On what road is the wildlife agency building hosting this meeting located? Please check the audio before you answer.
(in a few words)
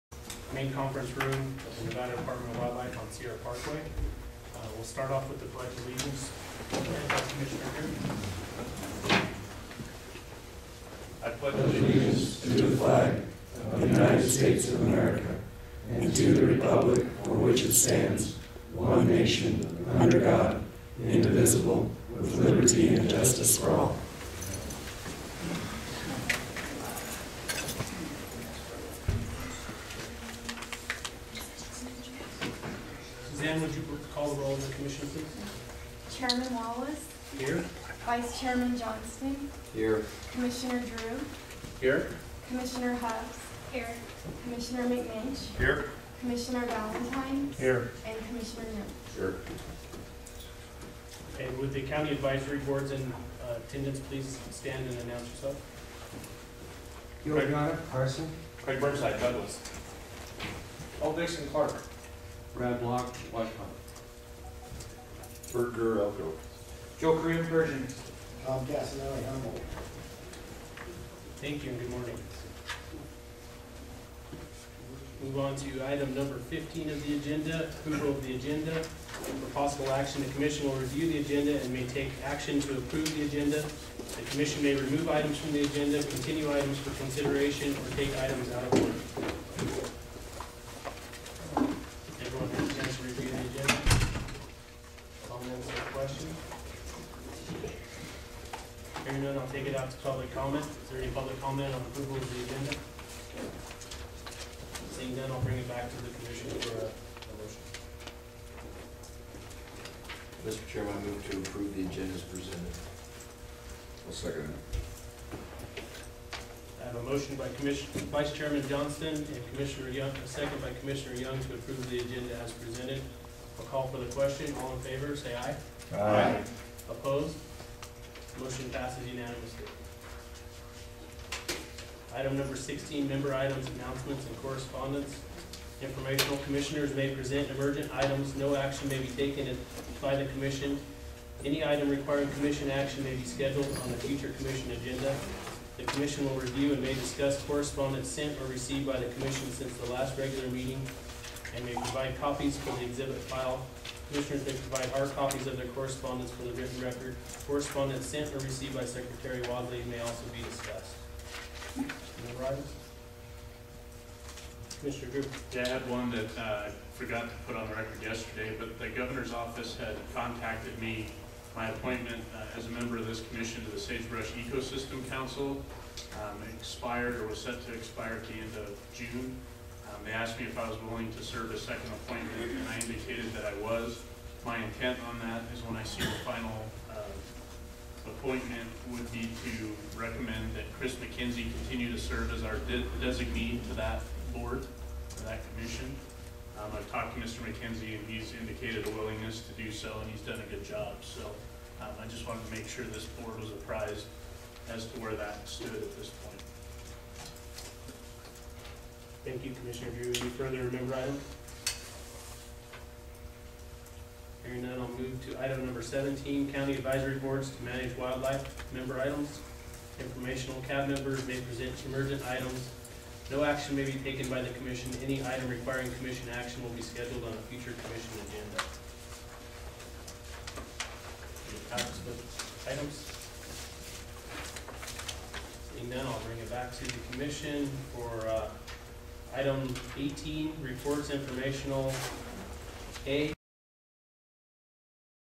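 Sierra Parkway.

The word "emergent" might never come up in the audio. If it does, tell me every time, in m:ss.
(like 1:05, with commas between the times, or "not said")
2:17, 3:41.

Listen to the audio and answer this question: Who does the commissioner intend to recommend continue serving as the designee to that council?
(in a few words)
Chris McKenzie.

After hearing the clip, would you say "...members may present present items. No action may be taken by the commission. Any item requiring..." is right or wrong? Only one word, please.
wrong.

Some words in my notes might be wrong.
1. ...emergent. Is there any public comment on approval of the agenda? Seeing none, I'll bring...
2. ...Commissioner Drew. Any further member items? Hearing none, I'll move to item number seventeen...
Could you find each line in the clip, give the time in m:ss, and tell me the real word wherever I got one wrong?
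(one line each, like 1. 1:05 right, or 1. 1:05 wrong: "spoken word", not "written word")
1. 1:40 wrong: "comment", not "emergent"
2. 3:29 right.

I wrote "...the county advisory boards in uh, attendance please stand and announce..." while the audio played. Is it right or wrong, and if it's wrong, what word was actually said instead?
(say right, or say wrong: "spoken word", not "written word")
right.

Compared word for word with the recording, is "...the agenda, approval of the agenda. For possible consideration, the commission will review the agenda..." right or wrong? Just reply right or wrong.
wrong.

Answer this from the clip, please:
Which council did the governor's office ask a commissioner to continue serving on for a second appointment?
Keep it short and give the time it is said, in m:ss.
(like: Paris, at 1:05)
Sagebrush Ecosystem Council, at 2:53.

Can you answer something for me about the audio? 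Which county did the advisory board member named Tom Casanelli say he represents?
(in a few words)
Humboldt.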